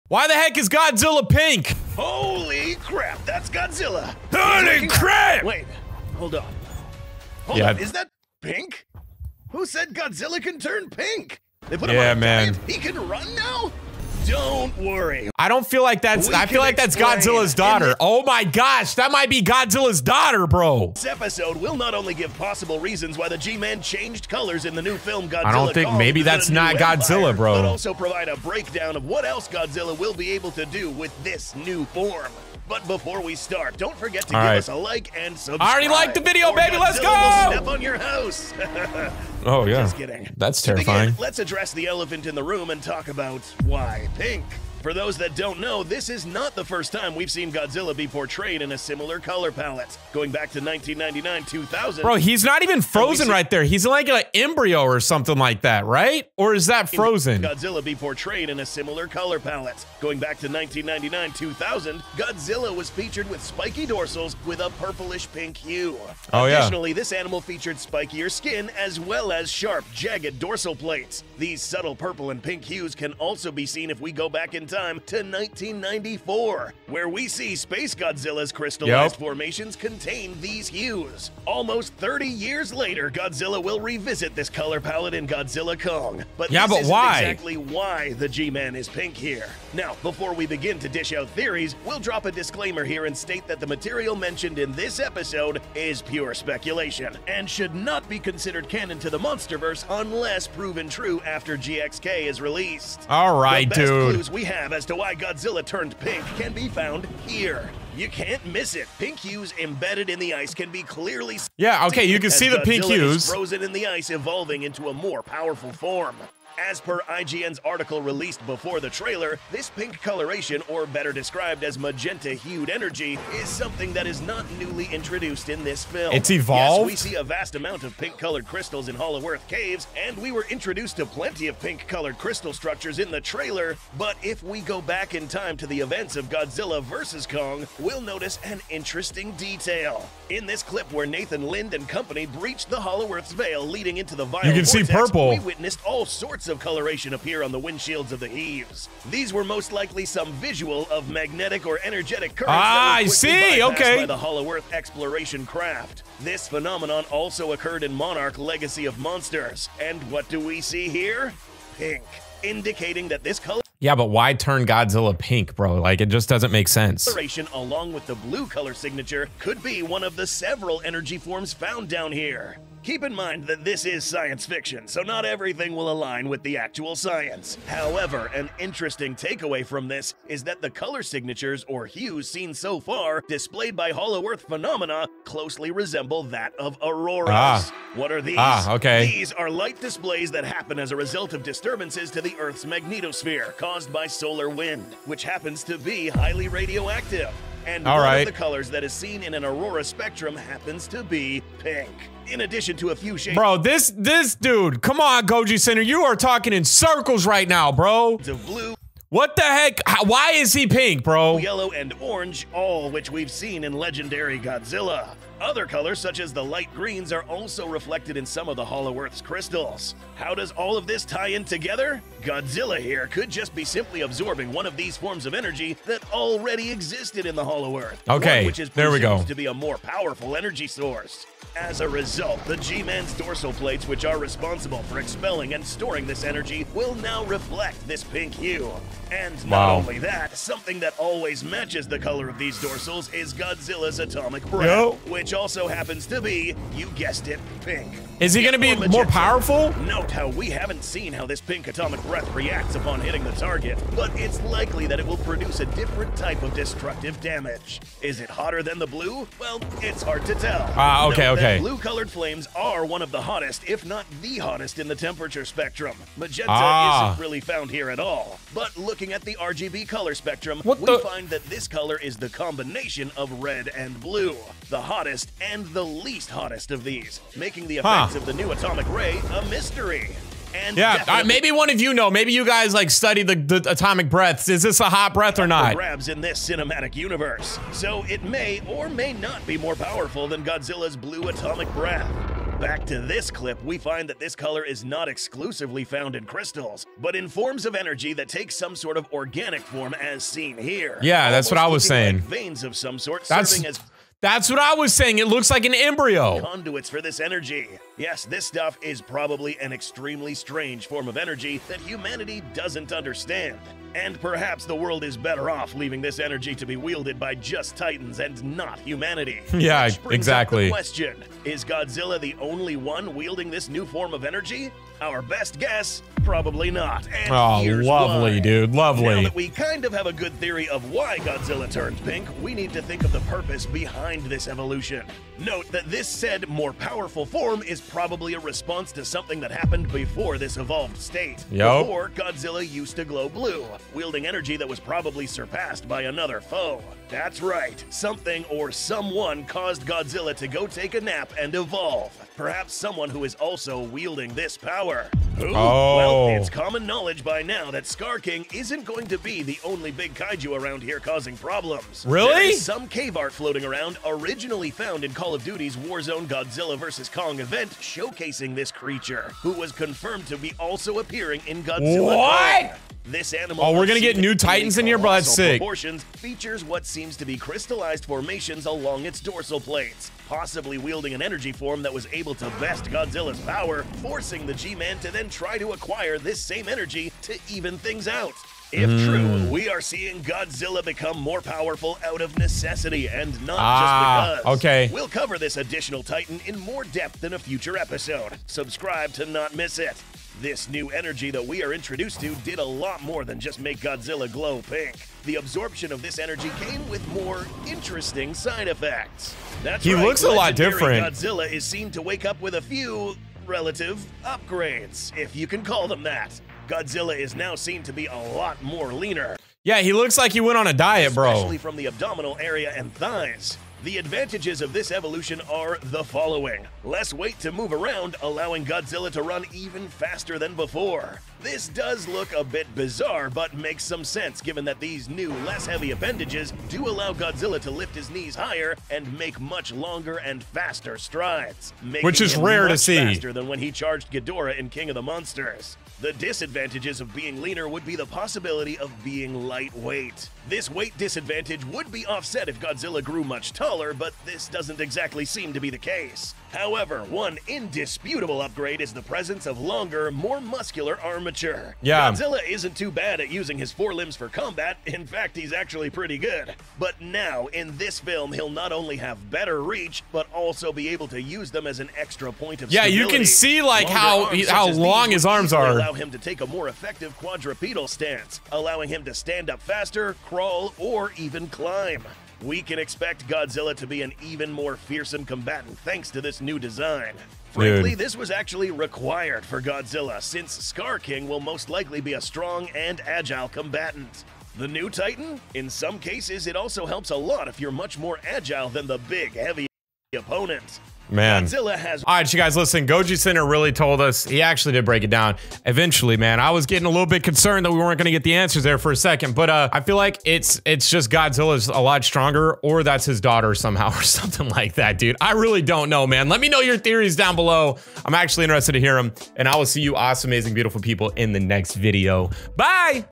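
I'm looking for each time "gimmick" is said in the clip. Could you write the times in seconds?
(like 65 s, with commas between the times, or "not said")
not said.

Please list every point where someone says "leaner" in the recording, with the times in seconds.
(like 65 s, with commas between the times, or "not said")
418 s, 447 s.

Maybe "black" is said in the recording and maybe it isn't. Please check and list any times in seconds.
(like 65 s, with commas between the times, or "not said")
not said.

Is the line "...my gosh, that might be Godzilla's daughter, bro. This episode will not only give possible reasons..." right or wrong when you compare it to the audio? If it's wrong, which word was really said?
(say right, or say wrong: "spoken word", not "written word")
right.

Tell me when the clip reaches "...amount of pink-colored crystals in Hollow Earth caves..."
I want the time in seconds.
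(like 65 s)
127 s.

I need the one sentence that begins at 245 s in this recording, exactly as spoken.
which also happens to be, you guessed it, pink.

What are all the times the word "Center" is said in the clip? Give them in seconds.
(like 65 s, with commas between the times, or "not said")
205 s, 503 s.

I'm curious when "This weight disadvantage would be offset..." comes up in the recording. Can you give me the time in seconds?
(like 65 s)
450 s.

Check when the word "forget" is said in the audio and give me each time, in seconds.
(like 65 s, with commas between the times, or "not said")
33 s.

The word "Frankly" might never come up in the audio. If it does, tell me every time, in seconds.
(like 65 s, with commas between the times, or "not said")
487 s.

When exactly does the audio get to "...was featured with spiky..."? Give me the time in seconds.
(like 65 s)
62 s.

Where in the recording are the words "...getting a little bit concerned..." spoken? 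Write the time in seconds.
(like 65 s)
506 s.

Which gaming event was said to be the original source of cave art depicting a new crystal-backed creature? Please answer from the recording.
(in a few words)
Call of Duty's Warzone.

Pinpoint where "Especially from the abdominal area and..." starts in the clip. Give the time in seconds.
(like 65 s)
421 s.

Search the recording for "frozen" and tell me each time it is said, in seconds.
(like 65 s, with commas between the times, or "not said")
52 s, 56 s, 113 s.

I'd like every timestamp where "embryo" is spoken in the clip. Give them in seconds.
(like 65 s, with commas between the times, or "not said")
54 s, 305 s.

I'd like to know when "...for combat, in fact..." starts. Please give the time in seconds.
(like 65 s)
464 s.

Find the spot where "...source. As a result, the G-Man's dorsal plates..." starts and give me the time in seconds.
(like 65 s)
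230 s.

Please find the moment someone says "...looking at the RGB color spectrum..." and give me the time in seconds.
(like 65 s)
268 s.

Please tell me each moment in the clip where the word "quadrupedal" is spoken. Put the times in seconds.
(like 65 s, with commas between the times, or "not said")
477 s.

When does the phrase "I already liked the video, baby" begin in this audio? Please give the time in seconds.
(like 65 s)
35 s.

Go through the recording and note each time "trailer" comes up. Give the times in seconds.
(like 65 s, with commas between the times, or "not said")
118 s, 133 s.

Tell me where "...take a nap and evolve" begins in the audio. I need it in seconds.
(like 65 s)
350 s.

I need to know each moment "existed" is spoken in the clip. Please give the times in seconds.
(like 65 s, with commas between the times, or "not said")
226 s.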